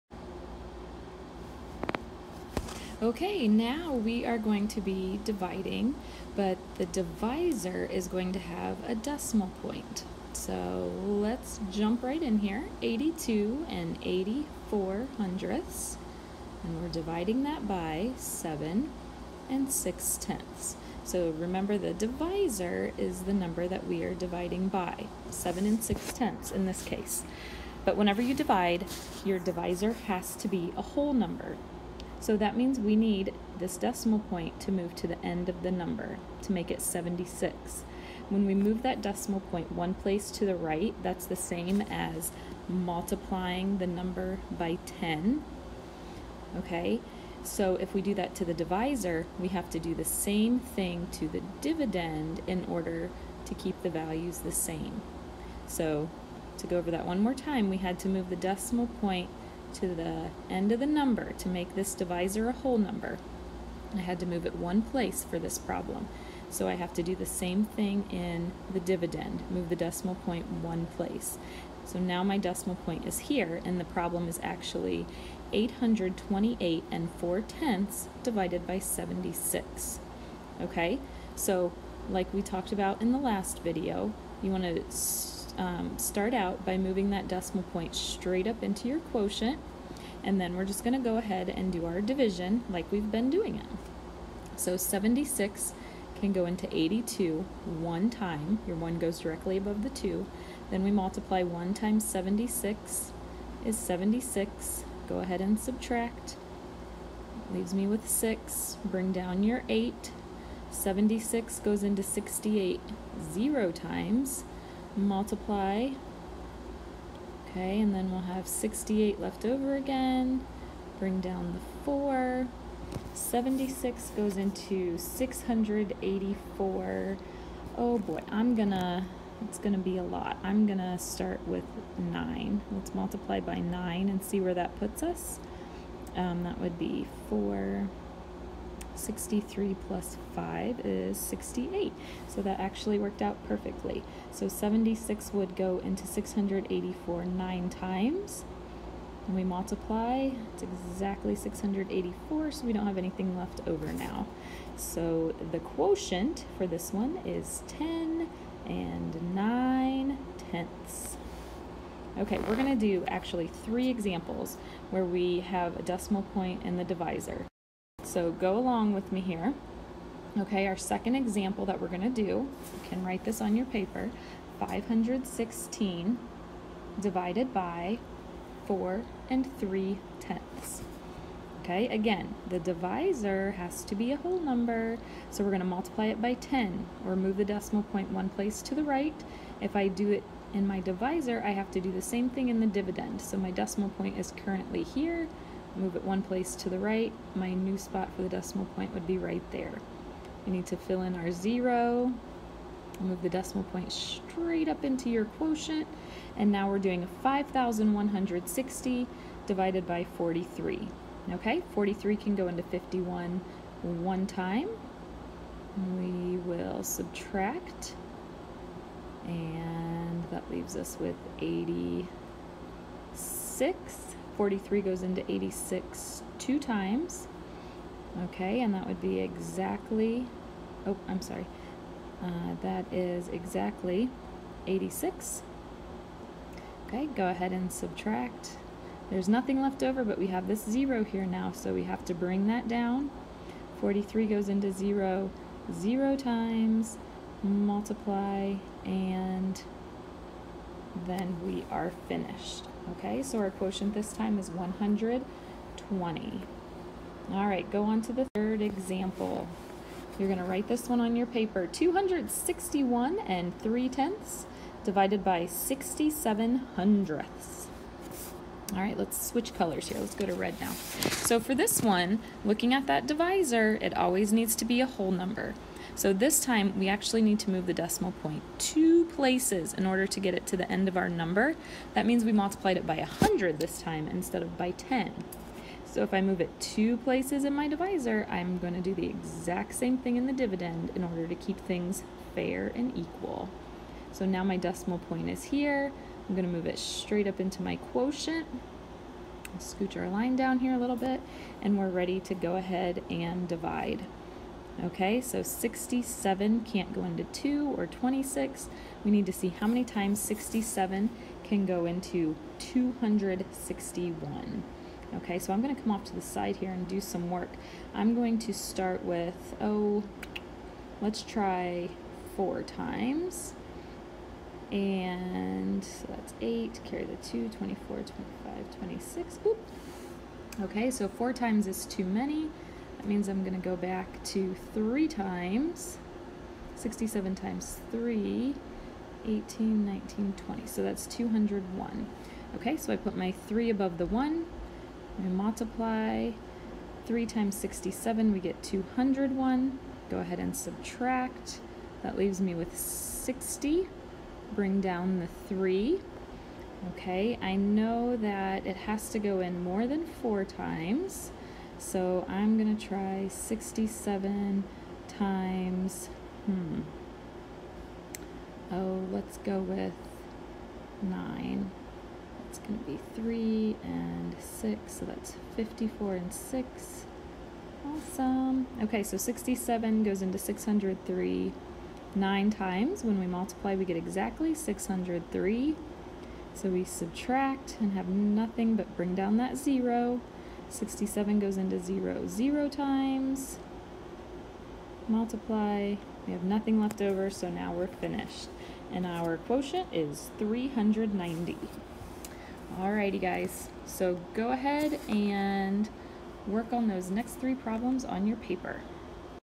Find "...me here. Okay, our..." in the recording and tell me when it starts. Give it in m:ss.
2:49.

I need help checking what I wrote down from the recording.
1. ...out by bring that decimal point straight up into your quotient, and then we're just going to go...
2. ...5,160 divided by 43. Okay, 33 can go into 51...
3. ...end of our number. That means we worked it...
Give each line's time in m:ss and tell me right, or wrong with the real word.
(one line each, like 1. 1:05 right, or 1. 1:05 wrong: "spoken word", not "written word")
1. 1:26 wrong: "moving", not "bring"
2. 3:27 wrong: "43", not "33"
3. 4:40 wrong: "multiplied", not "worked".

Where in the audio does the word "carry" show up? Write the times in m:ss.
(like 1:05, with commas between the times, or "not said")
5:26.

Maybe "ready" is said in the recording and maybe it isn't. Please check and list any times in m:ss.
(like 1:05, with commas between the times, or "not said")
5:01.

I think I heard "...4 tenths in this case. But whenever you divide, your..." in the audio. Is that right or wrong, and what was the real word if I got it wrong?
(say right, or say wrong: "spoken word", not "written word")
wrong: "6", not "4".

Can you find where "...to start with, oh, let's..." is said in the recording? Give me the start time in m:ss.
5:18.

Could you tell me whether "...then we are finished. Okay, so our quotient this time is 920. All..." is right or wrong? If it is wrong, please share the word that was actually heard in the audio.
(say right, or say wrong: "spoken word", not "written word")
wrong: "120", not "920".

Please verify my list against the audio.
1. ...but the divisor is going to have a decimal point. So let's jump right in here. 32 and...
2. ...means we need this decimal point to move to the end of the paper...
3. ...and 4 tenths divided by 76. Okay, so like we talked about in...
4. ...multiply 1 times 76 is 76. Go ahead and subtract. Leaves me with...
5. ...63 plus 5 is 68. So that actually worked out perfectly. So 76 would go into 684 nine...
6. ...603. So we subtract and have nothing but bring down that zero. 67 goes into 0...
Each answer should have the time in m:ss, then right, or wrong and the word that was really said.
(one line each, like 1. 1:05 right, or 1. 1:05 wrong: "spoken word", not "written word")
1. 0:06 wrong: "82", not "32"
2. 0:32 wrong: "number", not "paper"
3. 1:16 right
4. 1:40 right
5. 2:18 right
6. 6:24 right.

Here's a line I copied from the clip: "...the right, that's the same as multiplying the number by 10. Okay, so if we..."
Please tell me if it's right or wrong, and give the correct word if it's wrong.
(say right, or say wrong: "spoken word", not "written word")
right.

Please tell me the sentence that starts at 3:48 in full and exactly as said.
Okay, and that would be exactly, oh, I'm sorry.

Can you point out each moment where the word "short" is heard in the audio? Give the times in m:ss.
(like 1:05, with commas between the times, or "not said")
not said.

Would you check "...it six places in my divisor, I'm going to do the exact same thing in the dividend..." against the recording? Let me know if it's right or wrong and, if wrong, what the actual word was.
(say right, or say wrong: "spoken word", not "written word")
wrong: "two", not "six".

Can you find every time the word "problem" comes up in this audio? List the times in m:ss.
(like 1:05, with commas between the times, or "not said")
1:05, 1:13, 6:47.